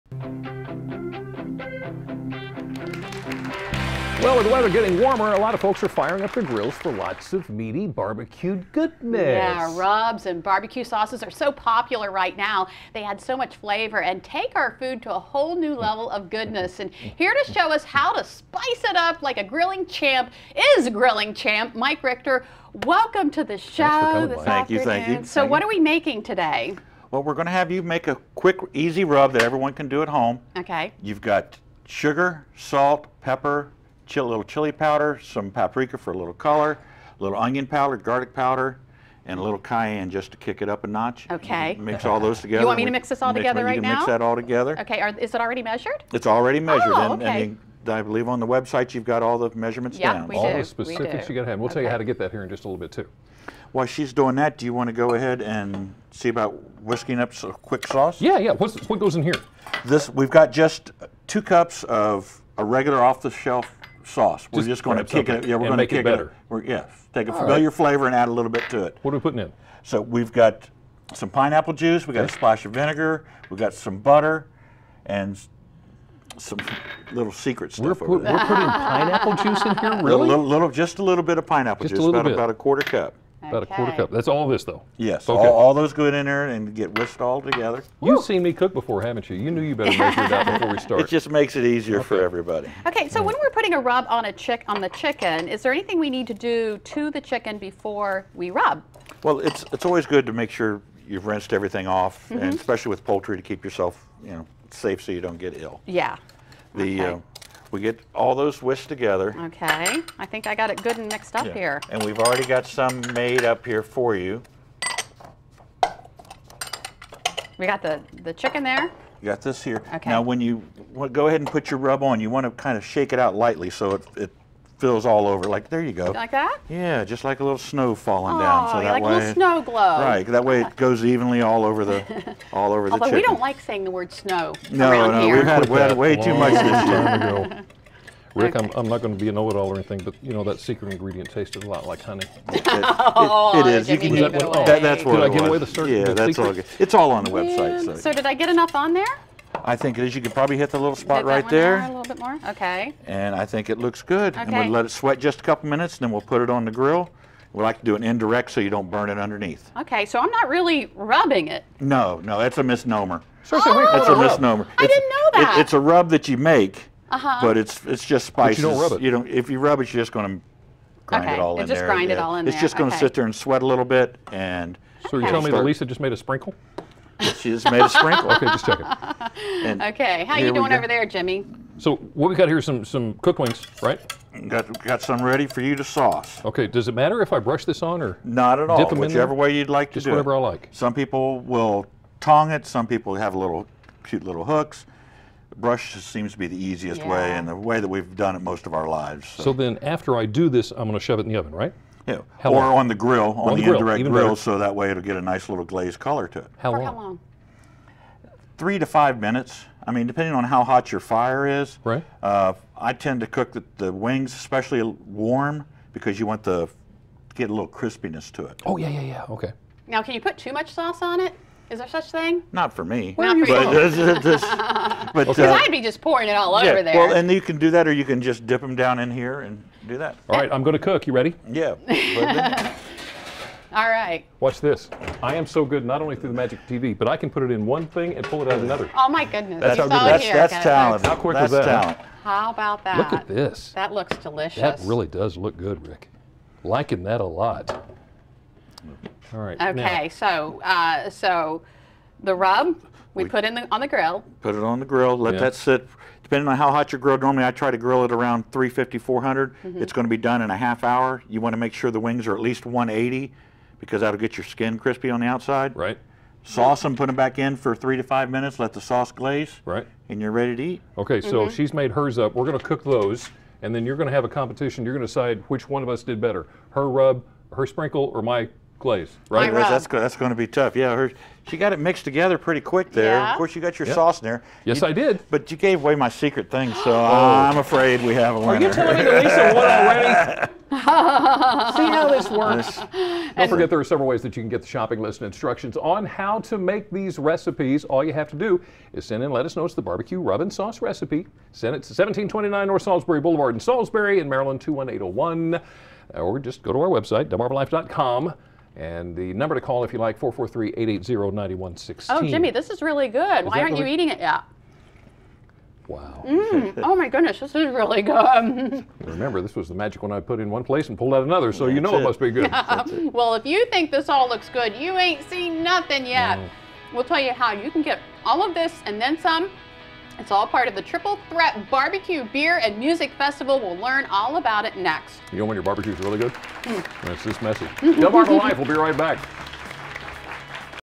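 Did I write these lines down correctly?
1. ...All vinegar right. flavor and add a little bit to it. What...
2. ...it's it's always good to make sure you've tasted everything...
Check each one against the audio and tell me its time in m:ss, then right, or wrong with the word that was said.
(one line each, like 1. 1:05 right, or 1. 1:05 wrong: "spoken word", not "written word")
1. 1:07 wrong: "familiar", not "vinegar"
2. 1:39 wrong: "rinsed", not "tasted".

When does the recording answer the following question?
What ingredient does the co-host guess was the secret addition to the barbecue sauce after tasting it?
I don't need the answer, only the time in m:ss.
2:22.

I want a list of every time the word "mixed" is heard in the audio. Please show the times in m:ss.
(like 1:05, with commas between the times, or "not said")
1:51, 4:41.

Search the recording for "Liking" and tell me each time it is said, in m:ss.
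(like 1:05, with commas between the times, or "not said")
4:06.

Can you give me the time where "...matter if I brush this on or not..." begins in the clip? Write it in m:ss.
3:06.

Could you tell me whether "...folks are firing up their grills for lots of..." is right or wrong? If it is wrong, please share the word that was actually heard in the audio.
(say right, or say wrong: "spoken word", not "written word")
right.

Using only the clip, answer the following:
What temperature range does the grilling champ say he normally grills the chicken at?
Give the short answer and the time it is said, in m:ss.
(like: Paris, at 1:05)
350 to 400, at 4:18.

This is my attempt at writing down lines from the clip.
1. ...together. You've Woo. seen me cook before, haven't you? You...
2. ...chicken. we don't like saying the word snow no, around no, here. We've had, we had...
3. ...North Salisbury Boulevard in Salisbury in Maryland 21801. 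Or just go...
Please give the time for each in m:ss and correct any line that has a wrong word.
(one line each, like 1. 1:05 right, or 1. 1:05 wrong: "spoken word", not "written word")
1. 1:27 right
2. 2:13 right
3. 5:02 right.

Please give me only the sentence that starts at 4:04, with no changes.
That really does look good, Rick.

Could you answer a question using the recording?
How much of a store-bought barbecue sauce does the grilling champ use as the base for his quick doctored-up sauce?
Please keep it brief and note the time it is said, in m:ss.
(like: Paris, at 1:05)
2 cups, at 1:01.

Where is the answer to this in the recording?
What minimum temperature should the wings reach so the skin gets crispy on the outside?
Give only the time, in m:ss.
4:22.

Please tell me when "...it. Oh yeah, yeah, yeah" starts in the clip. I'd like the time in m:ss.
3:38.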